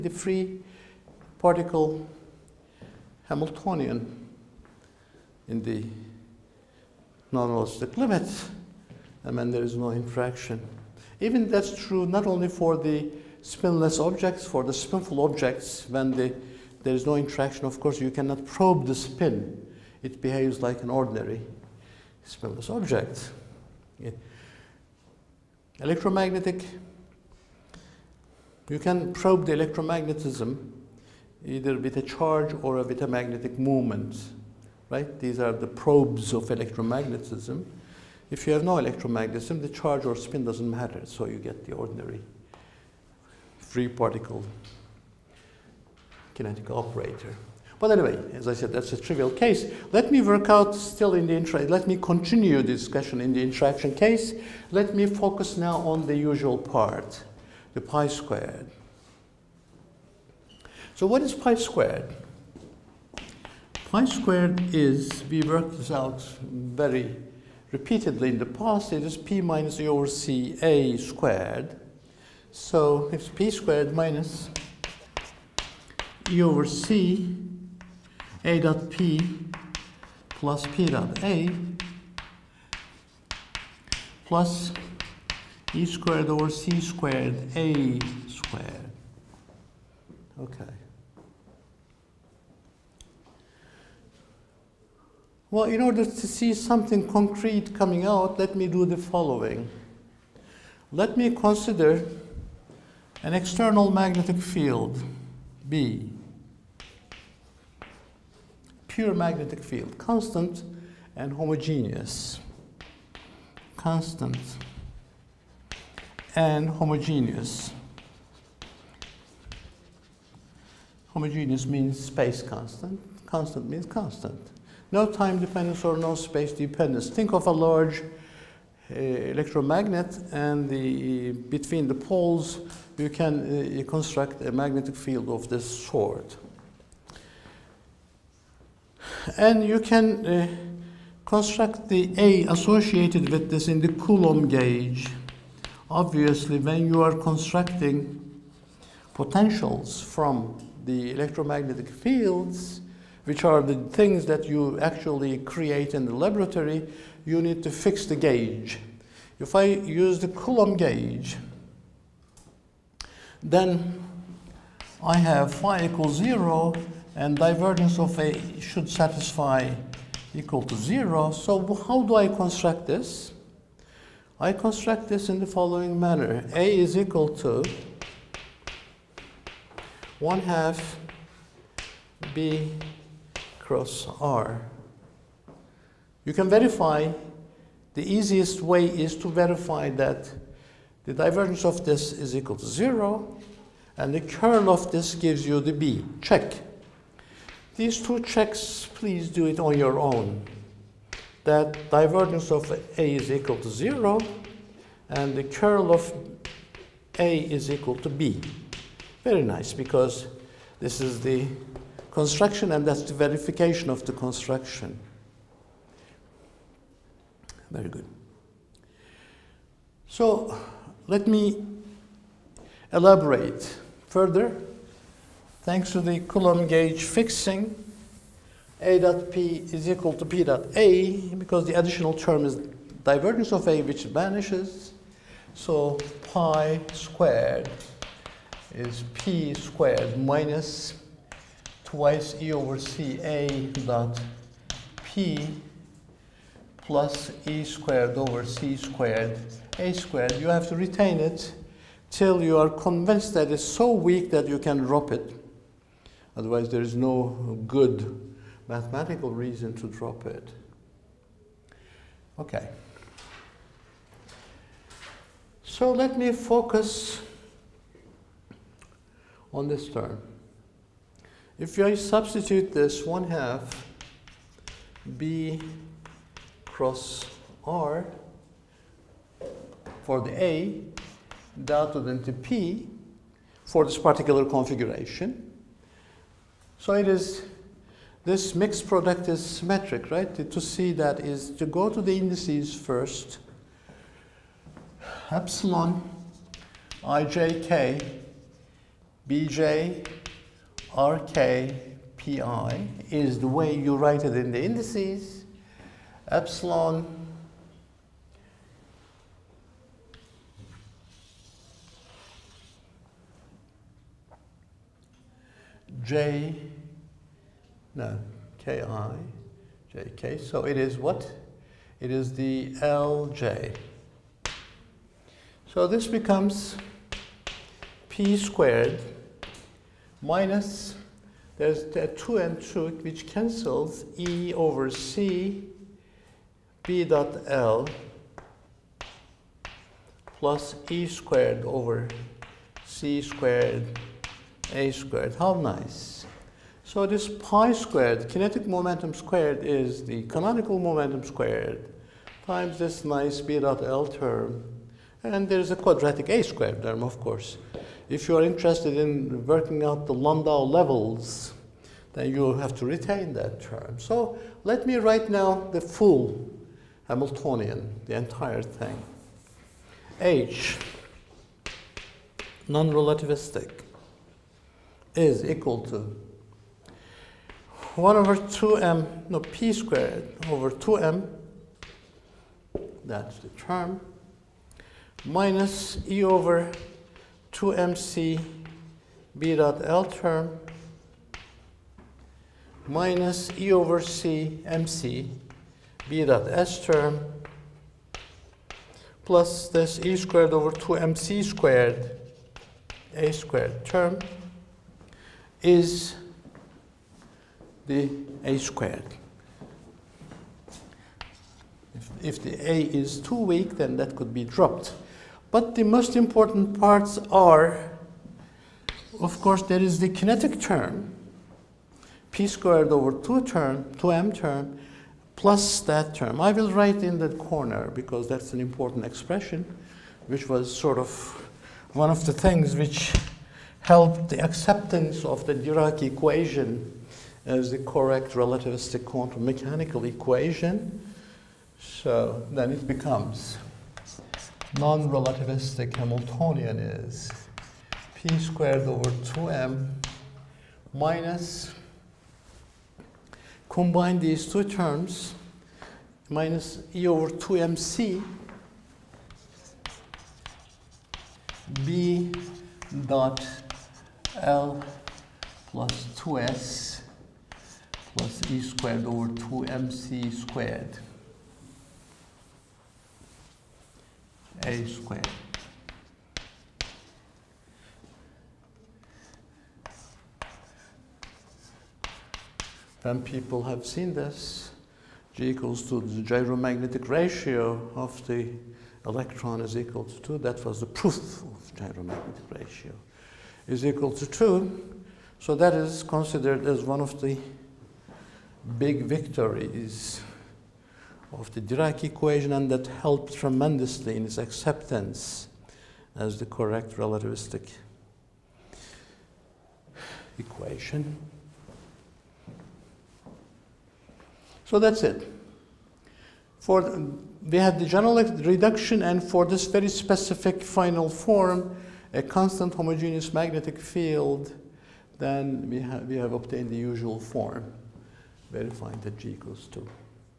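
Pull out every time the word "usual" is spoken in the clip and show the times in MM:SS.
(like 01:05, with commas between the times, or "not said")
00:56, 08:46.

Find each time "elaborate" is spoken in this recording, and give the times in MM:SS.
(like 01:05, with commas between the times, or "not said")
03:42.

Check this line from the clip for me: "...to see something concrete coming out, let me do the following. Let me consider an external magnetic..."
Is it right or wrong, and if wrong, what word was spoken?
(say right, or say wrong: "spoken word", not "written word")
right.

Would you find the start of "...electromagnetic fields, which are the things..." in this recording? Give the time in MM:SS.
02:31.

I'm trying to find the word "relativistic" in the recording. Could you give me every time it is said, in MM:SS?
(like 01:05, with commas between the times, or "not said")
06:12, 07:18, 07:24, 08:26.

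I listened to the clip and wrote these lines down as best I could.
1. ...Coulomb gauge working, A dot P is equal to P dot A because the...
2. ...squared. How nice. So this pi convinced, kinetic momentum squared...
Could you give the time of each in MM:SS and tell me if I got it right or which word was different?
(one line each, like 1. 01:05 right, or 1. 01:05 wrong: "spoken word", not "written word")
1. 03:46 wrong: "fixing", not "working"
2. 05:44 wrong: "squared", not "convinced".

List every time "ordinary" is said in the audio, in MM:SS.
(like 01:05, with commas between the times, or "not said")
00:20, 00:41.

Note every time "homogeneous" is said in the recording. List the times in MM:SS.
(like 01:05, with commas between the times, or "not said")
01:51, 01:56, 02:01, 08:42.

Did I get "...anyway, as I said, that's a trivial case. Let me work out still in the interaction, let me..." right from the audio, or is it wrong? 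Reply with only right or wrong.
right.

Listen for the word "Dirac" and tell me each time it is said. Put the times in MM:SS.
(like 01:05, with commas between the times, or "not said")
07:15, 08:21.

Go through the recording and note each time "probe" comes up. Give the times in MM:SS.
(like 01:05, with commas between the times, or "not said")
00:18, 00:29, 00:35.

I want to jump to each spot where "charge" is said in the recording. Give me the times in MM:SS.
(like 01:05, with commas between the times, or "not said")
00:32, 00:39.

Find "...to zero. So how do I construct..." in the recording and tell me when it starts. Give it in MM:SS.
02:50.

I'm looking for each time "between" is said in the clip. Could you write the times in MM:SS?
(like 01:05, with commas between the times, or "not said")
02:11.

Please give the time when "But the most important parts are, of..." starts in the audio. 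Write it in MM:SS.
06:55.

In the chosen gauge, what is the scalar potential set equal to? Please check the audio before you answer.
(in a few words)
0.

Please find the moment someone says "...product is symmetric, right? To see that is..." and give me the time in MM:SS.
04:48.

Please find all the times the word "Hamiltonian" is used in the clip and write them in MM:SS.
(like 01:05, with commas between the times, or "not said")
00:03, 06:07, 07:25.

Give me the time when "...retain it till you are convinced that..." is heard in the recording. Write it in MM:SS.
04:10.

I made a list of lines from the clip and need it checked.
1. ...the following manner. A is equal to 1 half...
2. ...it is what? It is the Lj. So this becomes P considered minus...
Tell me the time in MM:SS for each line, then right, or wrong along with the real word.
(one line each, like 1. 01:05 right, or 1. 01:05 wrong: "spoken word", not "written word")
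1. 02:55 right
2. 05:20 wrong: "squared", not "considered".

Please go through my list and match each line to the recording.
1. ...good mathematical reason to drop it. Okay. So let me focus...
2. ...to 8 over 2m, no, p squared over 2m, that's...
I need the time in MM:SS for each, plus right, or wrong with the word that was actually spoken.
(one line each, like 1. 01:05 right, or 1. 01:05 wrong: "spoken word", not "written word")
1. 04:17 right
2. 06:15 wrong: "1", not "8".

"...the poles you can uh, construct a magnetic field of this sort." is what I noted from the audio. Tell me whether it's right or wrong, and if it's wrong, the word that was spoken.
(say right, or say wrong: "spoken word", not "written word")
right.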